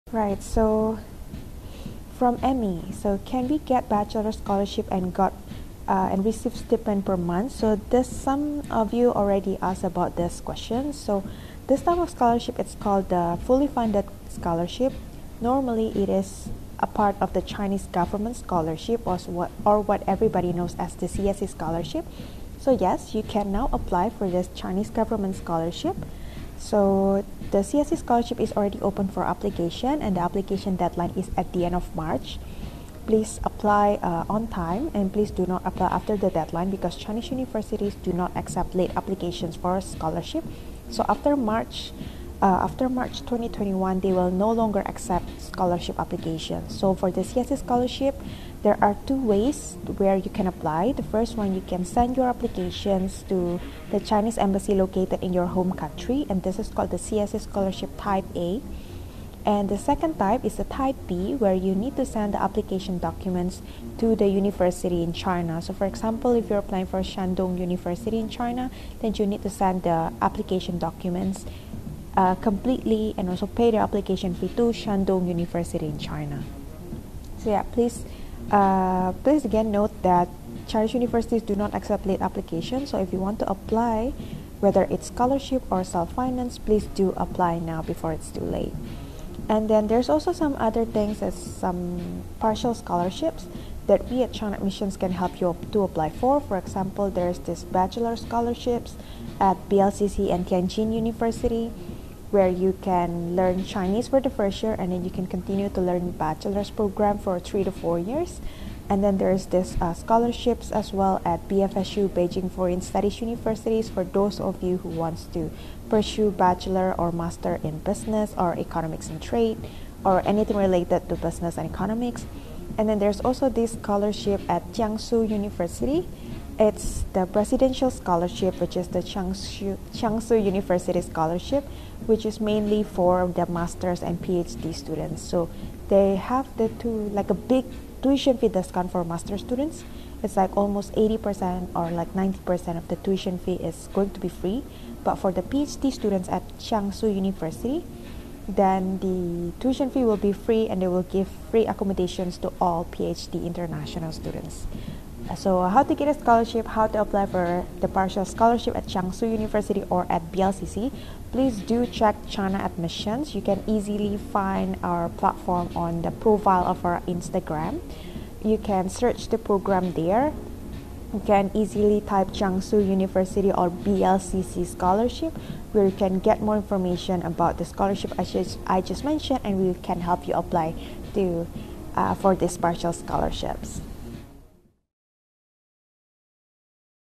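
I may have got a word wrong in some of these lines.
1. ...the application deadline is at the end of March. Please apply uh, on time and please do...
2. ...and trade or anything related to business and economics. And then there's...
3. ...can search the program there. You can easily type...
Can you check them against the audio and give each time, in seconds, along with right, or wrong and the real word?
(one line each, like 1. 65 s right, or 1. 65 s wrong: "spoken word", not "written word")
1. 30 s right
2. 119 s right
3. 168 s right.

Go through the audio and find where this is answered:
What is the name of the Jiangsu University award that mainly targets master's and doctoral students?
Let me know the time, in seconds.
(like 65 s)
127 s.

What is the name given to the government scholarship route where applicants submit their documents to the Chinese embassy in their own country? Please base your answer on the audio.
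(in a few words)
CSC Scholarship Type A.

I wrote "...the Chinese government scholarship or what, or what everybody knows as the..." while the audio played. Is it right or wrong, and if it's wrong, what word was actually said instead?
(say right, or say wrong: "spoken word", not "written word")
right.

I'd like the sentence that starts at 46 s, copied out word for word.
So for the CSC scholarship, there are two ways where you can apply.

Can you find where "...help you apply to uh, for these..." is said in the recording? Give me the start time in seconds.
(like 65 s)
180 s.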